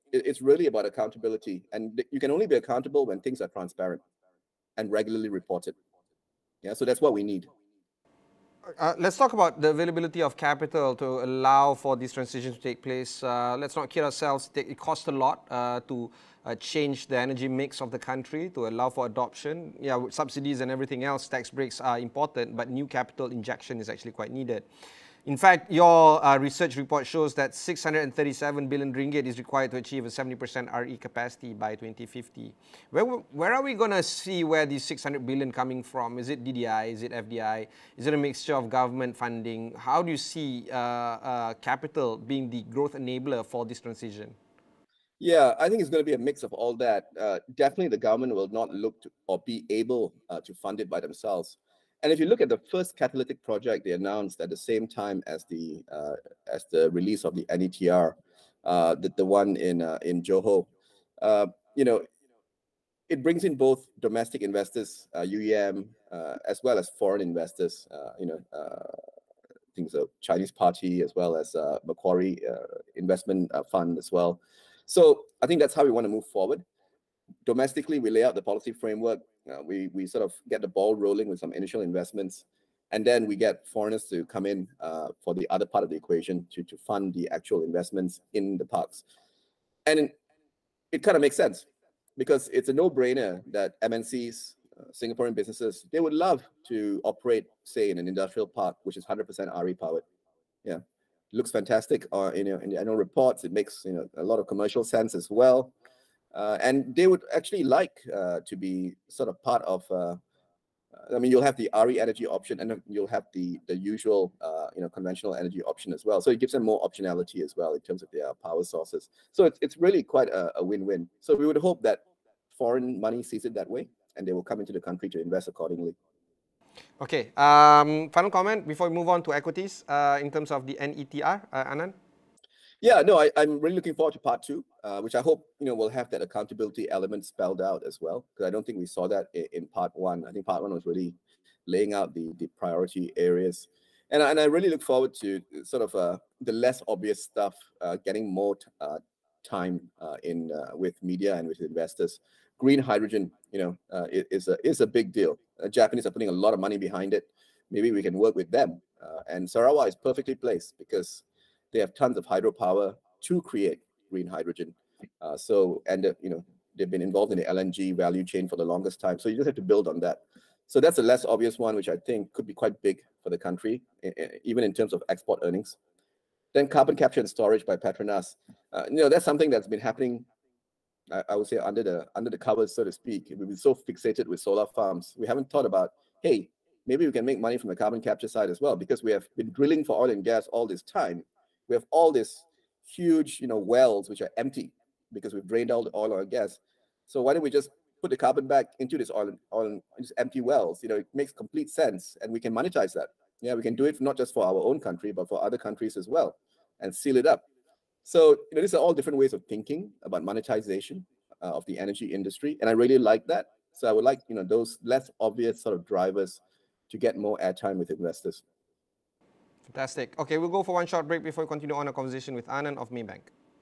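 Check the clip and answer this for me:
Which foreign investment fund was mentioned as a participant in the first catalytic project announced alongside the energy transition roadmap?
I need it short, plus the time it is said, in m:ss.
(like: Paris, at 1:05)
Macquarie Investment Fund, at 1:11.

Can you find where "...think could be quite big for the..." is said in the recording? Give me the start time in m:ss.
2:52.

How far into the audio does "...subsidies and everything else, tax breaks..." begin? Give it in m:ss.
0:20.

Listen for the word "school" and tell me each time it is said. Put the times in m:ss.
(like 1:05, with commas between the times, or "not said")
not said.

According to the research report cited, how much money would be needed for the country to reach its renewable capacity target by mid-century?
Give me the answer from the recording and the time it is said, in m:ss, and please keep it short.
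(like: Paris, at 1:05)
637 billion ringgit, at 0:27.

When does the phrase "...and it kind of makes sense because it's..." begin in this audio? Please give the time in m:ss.
1:29.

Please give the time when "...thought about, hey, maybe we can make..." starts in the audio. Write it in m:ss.
3:05.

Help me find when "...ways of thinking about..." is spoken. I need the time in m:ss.
3:29.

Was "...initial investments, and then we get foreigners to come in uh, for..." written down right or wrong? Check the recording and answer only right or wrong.
right.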